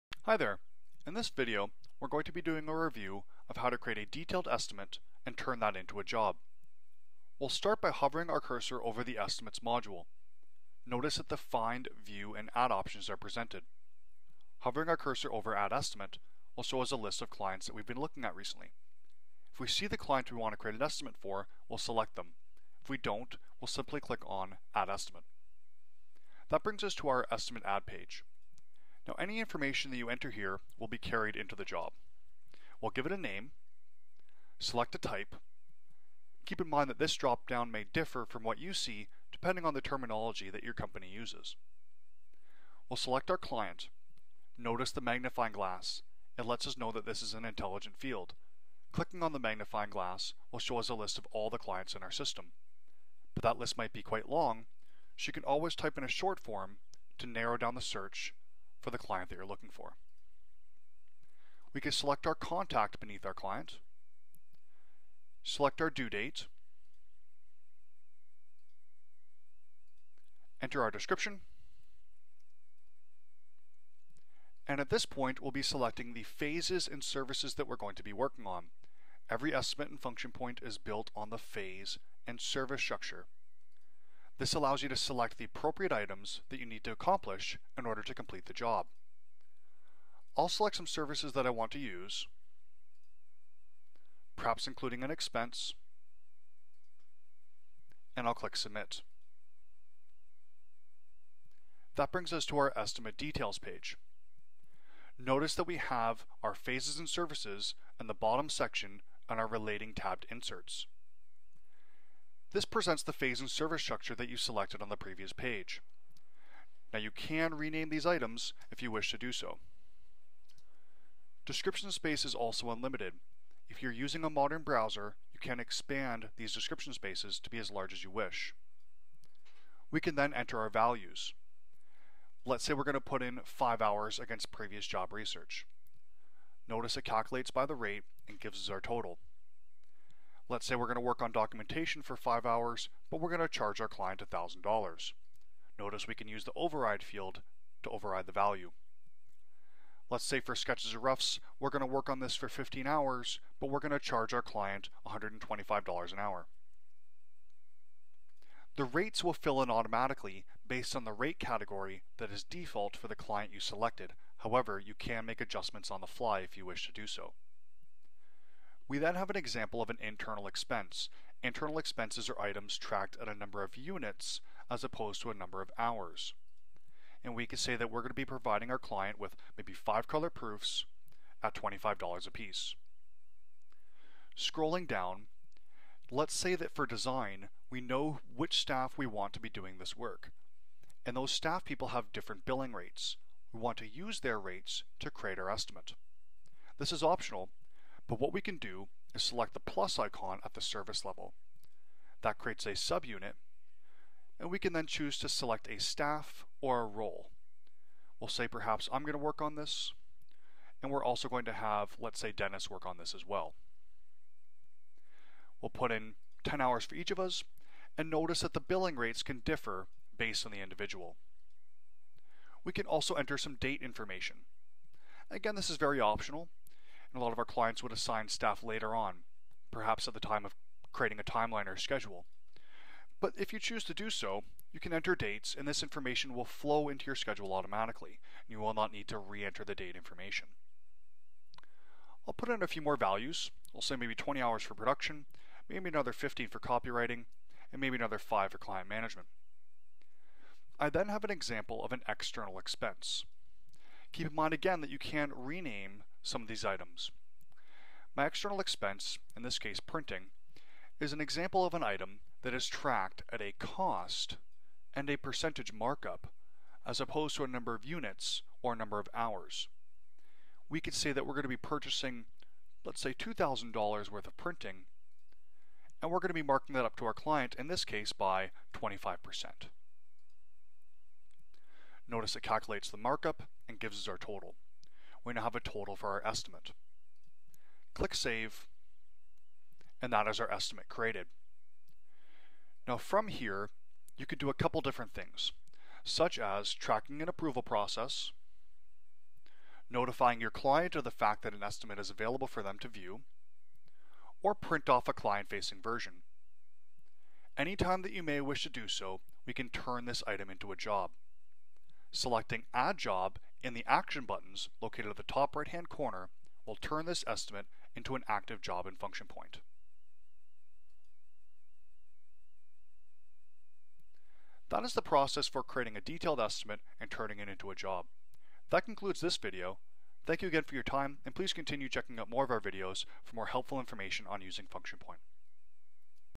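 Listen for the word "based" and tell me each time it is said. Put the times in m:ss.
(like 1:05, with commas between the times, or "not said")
2:40, 3:40.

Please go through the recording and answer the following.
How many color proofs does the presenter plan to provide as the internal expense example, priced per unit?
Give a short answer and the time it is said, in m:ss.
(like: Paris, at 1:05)
5, at 2:59.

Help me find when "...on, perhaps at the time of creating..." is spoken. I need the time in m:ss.
3:48.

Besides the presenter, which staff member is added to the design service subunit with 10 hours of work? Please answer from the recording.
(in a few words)
Dennis.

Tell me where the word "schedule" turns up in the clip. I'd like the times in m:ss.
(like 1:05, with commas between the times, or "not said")
3:51, 3:57.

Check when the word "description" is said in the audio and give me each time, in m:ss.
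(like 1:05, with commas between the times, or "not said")
1:10, 2:01, 2:06.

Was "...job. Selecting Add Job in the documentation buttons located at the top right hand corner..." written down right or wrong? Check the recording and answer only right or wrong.
wrong.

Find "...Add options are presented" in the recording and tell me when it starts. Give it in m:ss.
0:12.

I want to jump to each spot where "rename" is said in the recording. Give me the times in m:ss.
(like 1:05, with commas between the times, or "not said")
1:57, 4:15.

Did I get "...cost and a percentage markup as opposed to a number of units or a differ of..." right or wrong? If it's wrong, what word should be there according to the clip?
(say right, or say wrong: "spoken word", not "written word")
wrong: "number", not "differ".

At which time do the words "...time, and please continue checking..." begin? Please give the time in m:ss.
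5:30.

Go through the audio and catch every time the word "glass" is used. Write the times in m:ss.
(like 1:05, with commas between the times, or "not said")
0:45, 0:49.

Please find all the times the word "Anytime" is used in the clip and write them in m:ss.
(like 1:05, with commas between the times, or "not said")
5:07.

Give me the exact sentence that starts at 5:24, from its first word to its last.
That is the process for creating a detailed estimate and turning it into a job.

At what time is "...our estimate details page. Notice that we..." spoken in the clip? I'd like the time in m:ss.
1:42.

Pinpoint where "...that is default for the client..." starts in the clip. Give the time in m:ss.
2:42.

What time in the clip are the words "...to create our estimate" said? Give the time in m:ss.
3:14.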